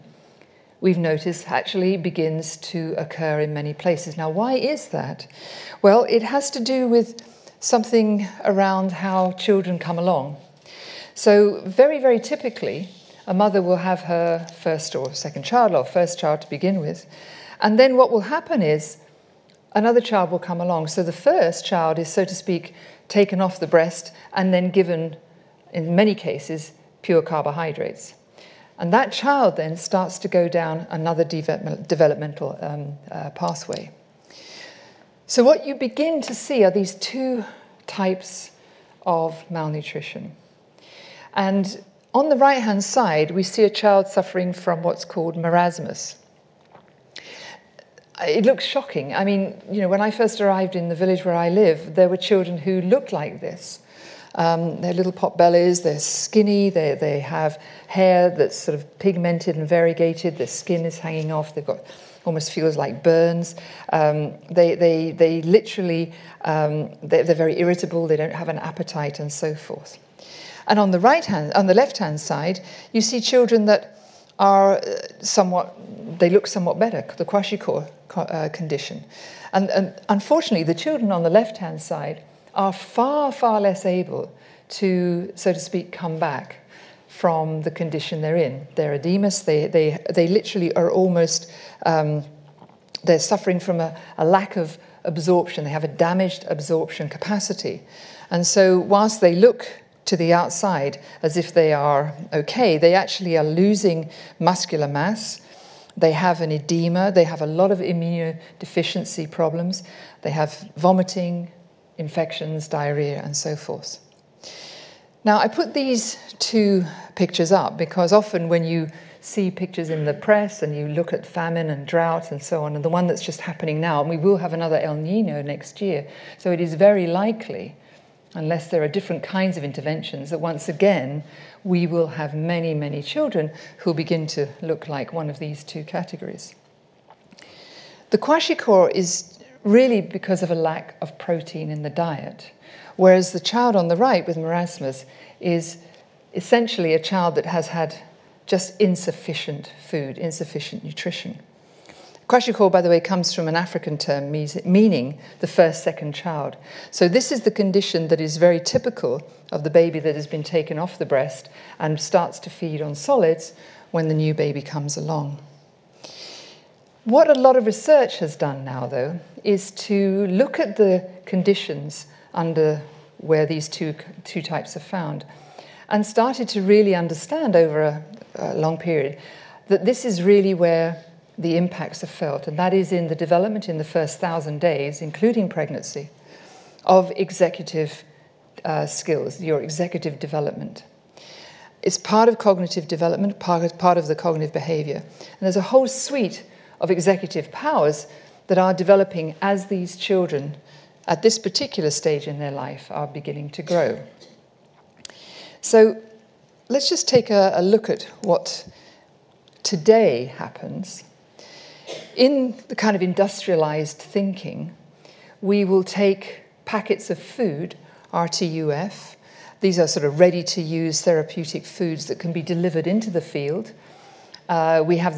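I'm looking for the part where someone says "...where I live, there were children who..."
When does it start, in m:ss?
0:51.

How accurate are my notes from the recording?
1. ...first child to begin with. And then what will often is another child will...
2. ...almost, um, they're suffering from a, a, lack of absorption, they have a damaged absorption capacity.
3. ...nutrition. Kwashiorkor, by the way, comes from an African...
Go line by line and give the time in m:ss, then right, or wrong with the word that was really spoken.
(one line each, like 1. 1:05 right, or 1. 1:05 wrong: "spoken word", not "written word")
1. 0:15 wrong: "happen", not "often"
2. 1:30 right
3. 2:30 right.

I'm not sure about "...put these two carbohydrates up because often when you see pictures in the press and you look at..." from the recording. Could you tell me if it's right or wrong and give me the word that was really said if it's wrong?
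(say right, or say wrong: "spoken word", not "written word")
wrong: "pictures", not "carbohydrates".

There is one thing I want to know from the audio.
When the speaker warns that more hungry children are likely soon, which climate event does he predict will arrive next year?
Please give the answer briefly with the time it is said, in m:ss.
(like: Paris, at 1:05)
El Nino, at 2:04.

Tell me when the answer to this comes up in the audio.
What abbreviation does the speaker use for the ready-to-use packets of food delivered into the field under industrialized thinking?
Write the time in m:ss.
3:38.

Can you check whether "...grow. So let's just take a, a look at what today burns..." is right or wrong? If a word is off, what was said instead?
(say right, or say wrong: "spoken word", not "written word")
wrong: "happens", not "burns".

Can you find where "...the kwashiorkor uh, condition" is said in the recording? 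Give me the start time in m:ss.
1:17.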